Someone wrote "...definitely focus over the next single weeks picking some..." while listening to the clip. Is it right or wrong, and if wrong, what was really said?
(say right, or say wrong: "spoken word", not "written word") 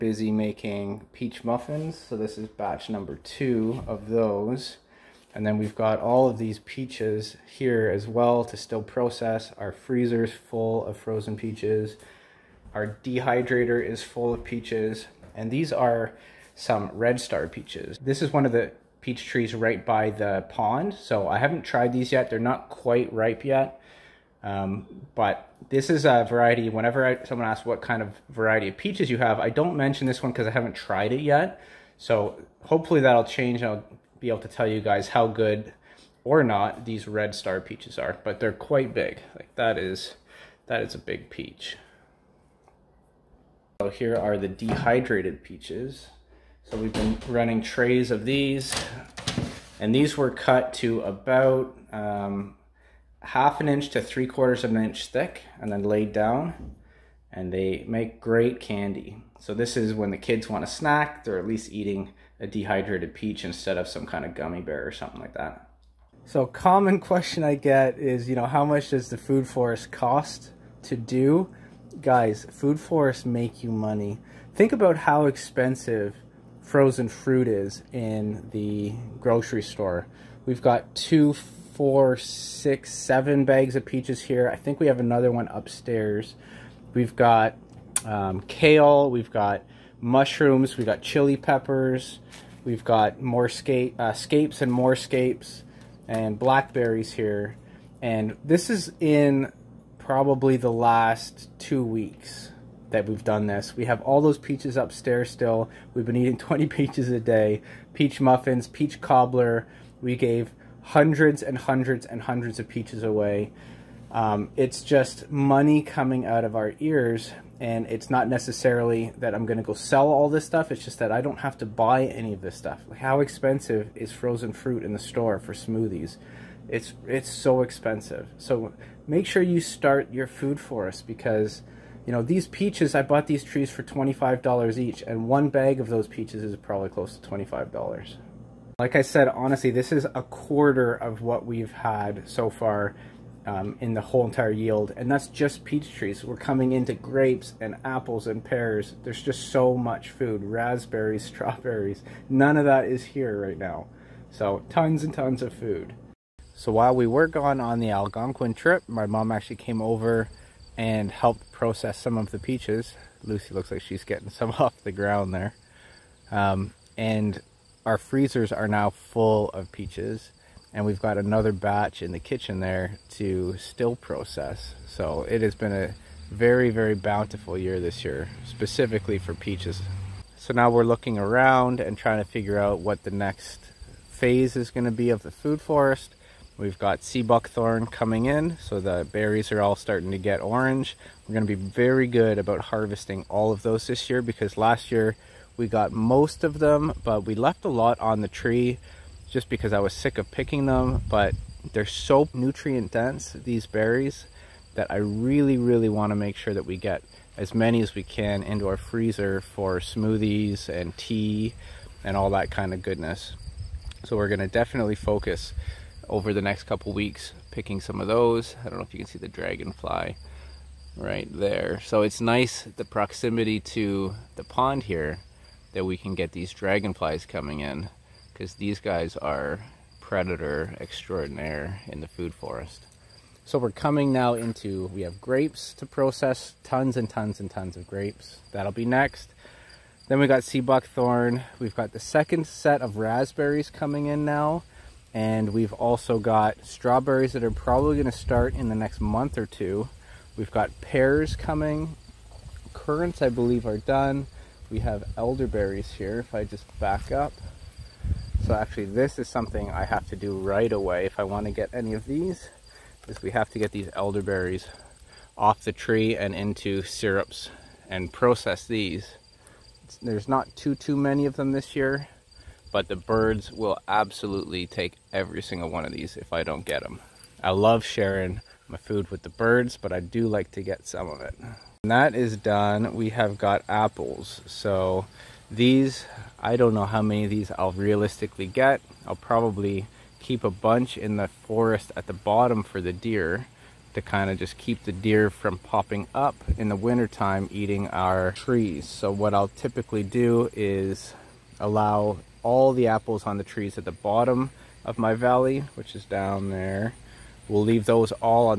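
wrong: "couple", not "single".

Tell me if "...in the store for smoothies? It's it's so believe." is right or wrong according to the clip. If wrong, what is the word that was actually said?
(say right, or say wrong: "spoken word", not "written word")
wrong: "expensive", not "believe".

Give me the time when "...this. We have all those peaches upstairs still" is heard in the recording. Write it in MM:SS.
01:43.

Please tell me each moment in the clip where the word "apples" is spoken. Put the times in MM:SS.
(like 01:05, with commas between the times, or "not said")
02:27, 04:43, 05:02.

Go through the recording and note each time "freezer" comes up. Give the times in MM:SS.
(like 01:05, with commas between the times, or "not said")
00:09, 02:47, 03:28.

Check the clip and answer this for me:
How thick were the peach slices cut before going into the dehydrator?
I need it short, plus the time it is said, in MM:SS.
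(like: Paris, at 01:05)
1/2 to 3/4 inch, at 00:53.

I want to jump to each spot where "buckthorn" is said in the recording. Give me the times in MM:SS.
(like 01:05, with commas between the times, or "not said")
03:07, 04:00.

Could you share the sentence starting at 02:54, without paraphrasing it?
So it has been a very, very bountiful year this year, specifically for peaches.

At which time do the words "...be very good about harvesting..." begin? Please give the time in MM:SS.
03:11.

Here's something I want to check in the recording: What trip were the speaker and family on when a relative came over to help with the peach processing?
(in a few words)
Algonquin trip.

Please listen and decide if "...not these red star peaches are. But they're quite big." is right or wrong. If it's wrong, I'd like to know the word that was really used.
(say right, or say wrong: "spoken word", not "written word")
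right.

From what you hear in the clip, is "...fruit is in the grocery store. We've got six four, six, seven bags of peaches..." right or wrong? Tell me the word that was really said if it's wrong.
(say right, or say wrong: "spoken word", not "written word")
wrong: "two", not "six".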